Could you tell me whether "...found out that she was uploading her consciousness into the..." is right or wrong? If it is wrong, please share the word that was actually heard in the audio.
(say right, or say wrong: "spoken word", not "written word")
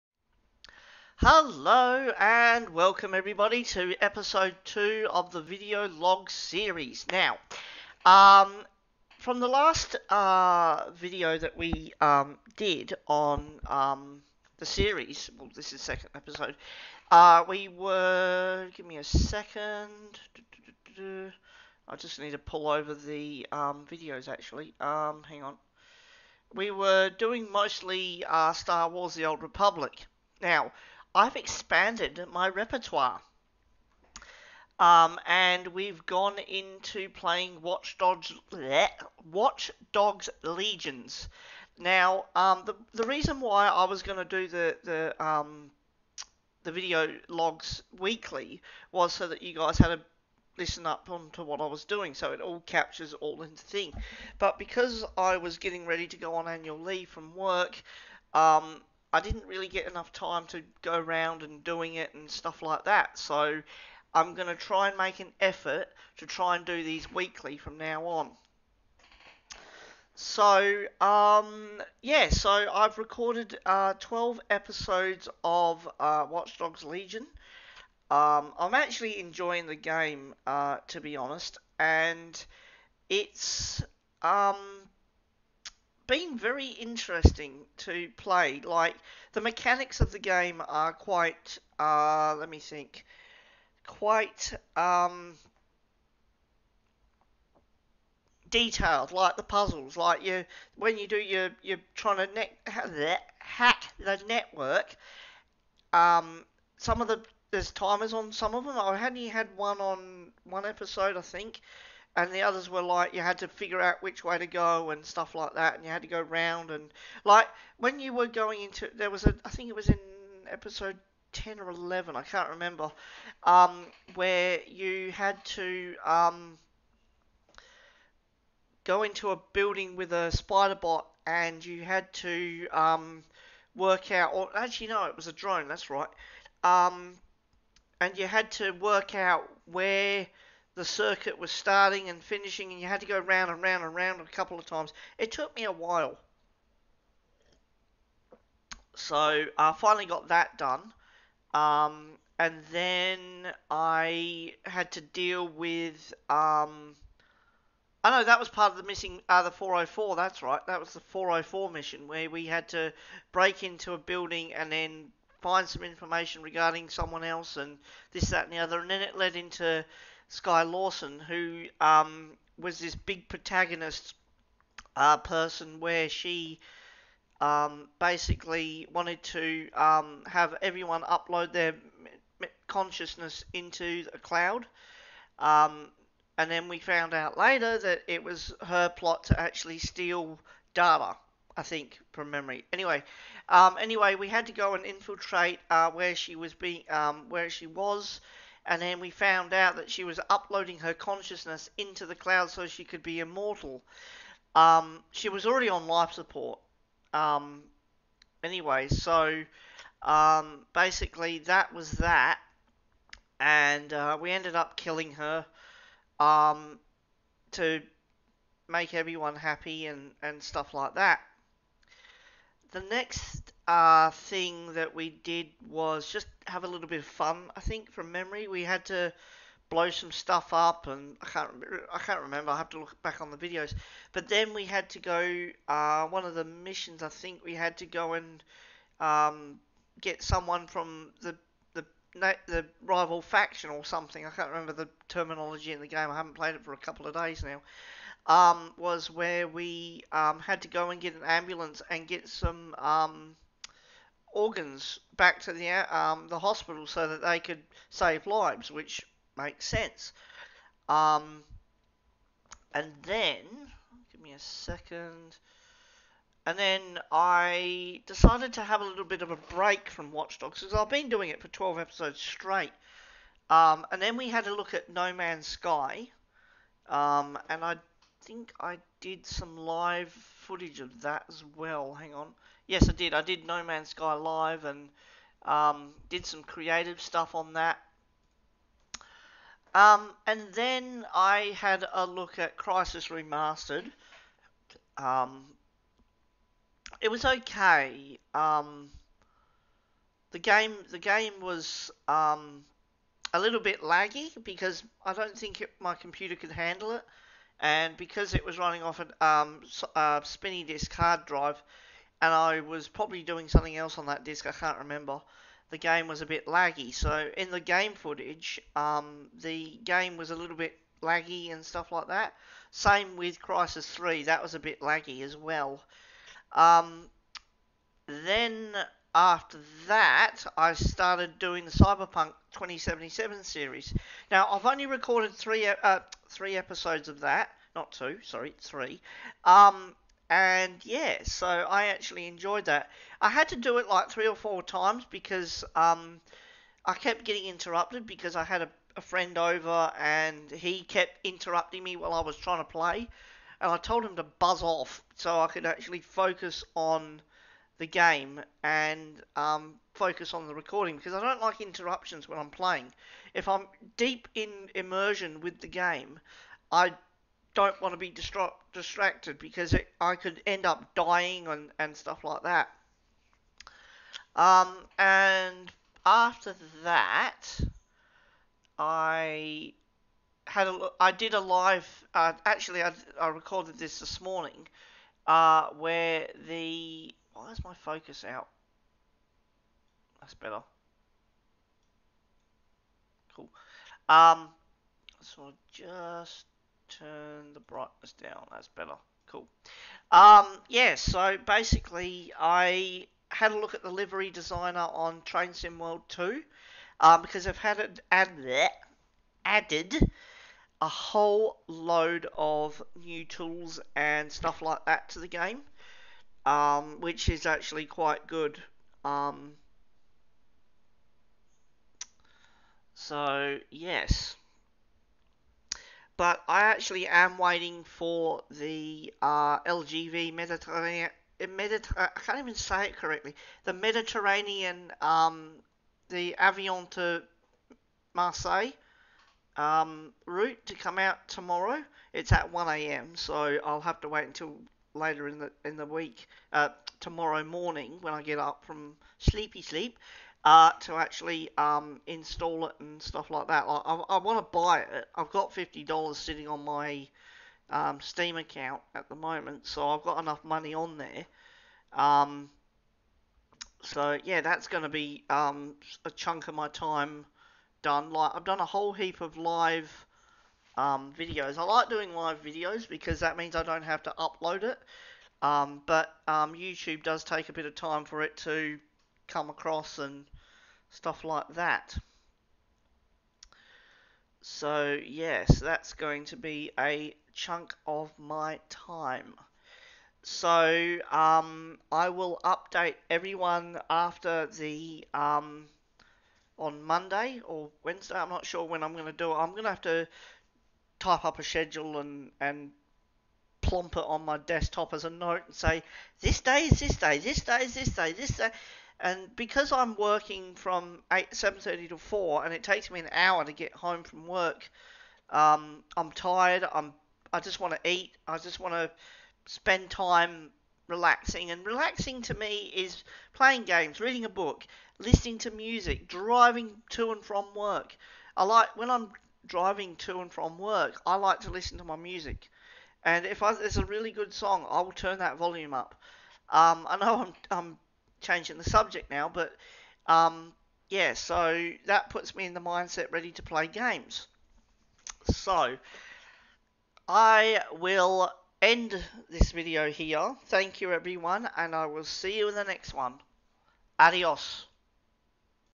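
right.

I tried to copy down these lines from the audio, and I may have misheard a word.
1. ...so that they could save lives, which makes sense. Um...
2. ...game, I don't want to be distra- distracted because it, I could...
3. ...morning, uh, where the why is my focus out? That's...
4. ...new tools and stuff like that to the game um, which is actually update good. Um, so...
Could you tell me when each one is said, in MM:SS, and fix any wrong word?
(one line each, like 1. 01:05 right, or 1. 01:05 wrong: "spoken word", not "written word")
1. 04:16 right
2. 06:05 right
3. 06:24 right
4. 06:52 wrong: "quite", not "update".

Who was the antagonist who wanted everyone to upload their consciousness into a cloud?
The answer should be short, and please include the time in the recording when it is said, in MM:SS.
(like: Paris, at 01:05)
Skye Larsen, at 02:50.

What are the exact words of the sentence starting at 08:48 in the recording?
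I like when I'm driving to and from work, I like to listen to my music.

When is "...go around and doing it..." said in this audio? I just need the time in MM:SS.
01:00.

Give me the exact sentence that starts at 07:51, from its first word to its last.
I like doing live videos because that means I don't have to upload it.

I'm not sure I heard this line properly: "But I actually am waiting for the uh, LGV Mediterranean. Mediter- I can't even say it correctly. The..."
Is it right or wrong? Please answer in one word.
right.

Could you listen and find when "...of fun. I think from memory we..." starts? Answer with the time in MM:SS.
03:46.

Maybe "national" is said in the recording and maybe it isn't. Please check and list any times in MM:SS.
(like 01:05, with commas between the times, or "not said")
not said.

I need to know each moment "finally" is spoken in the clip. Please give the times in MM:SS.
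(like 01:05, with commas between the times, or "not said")
02:29.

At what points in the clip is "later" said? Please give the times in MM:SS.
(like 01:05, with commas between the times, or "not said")
03:07, 07:24.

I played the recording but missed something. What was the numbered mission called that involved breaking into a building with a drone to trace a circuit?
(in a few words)
404.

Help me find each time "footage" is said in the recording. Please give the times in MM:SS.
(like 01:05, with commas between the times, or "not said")
04:40, 05:17.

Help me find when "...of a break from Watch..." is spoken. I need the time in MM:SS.
04:29.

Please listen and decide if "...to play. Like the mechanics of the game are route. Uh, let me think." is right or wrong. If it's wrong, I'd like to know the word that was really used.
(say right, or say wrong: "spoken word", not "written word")
wrong: "quite", not "route".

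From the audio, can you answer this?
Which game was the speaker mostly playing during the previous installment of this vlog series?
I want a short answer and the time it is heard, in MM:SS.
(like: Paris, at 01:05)
Star Wars The Old Republic, at 00:28.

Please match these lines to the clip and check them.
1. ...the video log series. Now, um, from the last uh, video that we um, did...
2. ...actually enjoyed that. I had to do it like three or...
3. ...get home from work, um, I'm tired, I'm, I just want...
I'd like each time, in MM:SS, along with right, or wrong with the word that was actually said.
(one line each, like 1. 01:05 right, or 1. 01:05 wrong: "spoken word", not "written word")
1. 00:05 right
2. 05:41 right
3. 08:33 right.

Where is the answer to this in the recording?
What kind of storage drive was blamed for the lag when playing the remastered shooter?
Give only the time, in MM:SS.
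05:10.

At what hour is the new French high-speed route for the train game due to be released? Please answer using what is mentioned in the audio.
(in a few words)
1 a.m.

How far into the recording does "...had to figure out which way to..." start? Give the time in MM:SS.
01:53.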